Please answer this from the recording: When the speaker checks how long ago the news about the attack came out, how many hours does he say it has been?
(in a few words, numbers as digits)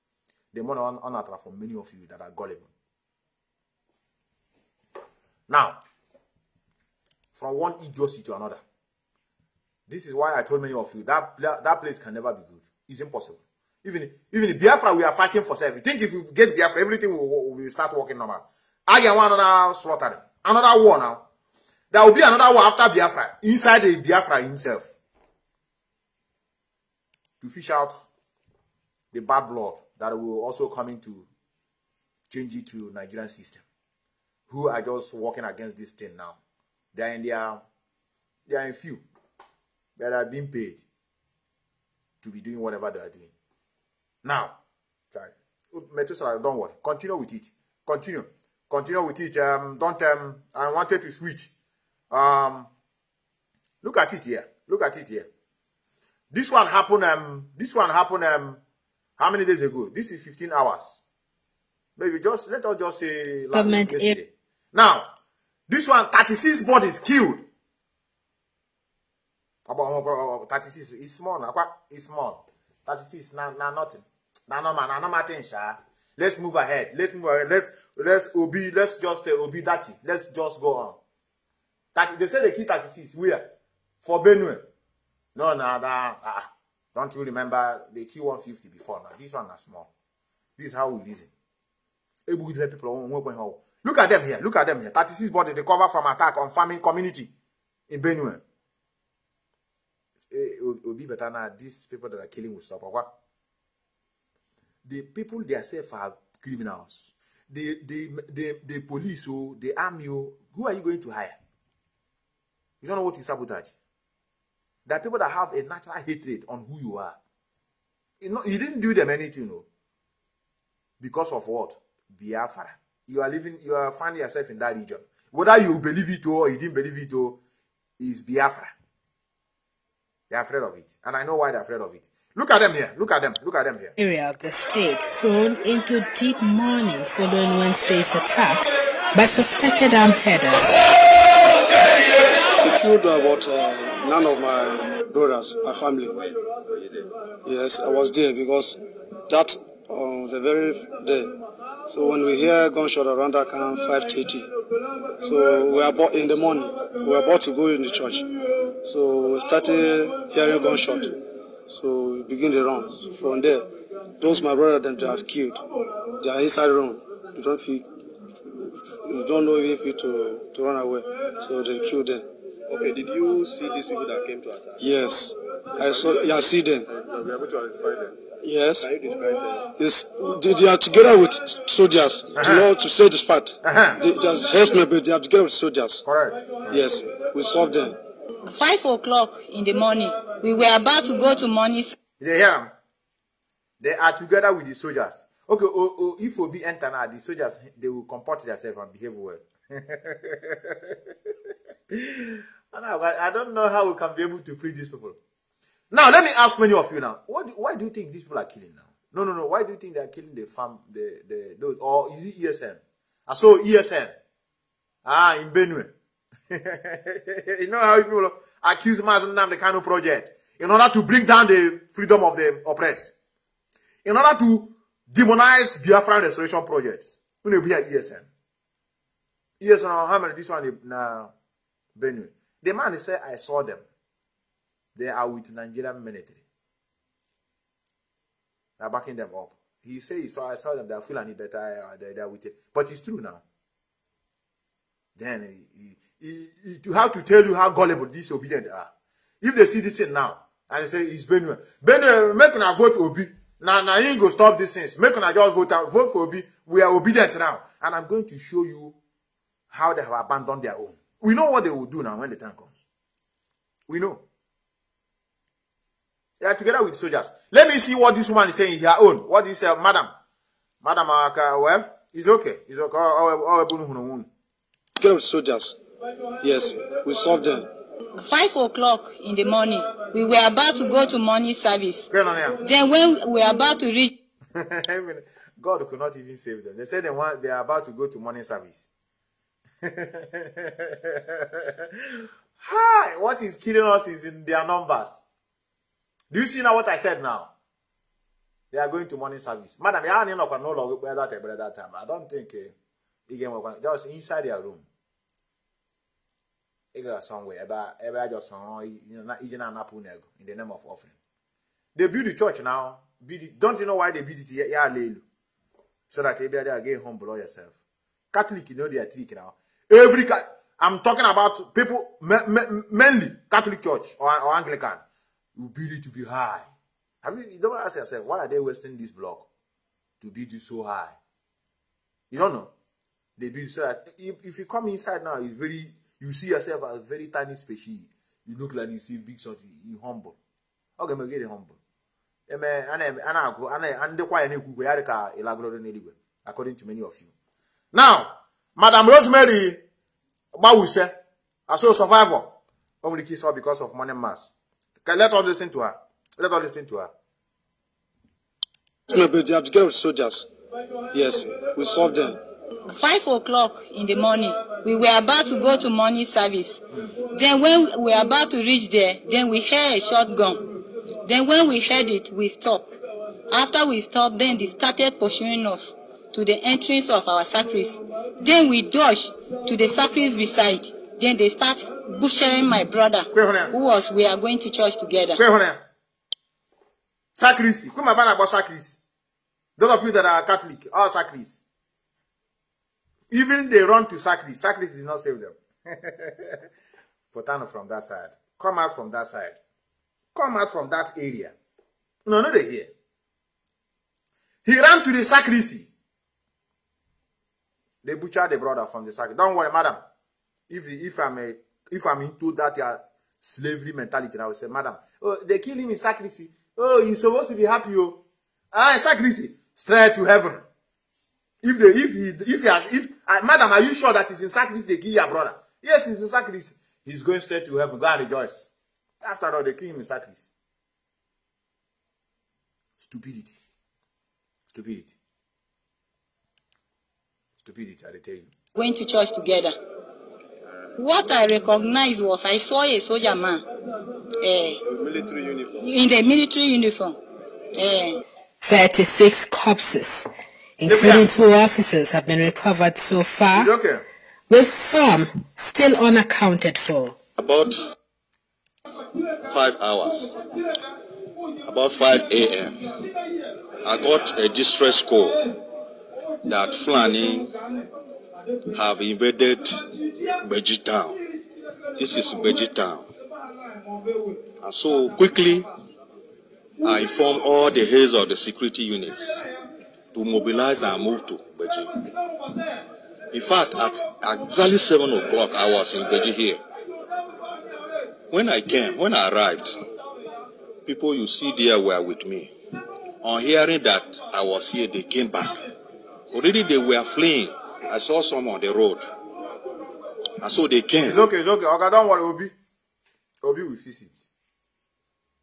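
15 hours.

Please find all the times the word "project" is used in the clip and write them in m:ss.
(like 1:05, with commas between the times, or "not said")
3:39, 3:46.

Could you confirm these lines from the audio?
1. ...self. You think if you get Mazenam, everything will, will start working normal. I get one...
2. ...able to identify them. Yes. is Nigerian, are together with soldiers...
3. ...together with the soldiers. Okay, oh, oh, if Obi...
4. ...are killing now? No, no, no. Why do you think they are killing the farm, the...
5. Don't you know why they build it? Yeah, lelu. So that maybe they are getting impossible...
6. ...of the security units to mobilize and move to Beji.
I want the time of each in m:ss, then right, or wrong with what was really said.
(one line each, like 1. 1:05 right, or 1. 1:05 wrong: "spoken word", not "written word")
1. 0:15 wrong: "Biafra", not "Mazenam"
2. 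2:57 wrong: "They", not "Nigerian"
3. 3:14 right
4. 3:28 right
5. 5:13 wrong: "humble", not "impossible"
6. 7:58 right.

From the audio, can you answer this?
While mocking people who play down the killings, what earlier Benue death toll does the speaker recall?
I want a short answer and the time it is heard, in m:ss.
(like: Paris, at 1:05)
50, at 1:28.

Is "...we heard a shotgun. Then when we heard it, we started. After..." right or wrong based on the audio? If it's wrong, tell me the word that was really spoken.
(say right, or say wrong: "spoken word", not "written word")
wrong: "stopped", not "started".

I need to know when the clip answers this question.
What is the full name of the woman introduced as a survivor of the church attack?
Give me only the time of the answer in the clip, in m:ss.
5:49.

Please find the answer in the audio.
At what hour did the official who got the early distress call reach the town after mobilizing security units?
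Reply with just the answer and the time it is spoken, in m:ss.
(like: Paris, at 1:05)
7 o'clock, at 8:04.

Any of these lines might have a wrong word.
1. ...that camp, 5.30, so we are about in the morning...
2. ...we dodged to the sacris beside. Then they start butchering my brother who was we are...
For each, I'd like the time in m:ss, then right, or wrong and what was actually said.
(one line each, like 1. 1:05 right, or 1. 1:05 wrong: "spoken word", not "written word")
1. 2:33 right
2. 6:18 right.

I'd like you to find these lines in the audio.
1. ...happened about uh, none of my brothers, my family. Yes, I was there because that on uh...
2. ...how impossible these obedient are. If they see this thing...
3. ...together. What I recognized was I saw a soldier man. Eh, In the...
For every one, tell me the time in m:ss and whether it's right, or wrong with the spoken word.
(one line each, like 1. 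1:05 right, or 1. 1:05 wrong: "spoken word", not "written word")
1. 2:22 wrong: "killed", not "happened"
2. 4:07 wrong: "gullible", not "impossible"
3. 7:19 right.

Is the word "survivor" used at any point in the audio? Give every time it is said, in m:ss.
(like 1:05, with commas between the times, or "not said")
5:51.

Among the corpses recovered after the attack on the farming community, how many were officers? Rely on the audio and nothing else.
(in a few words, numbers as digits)
2.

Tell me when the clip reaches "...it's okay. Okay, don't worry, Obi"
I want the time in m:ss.
8:21.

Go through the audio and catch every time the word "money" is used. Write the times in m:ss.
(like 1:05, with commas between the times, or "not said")
0:00, 5:53.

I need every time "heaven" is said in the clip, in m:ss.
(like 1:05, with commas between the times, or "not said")
7:00, 7:07.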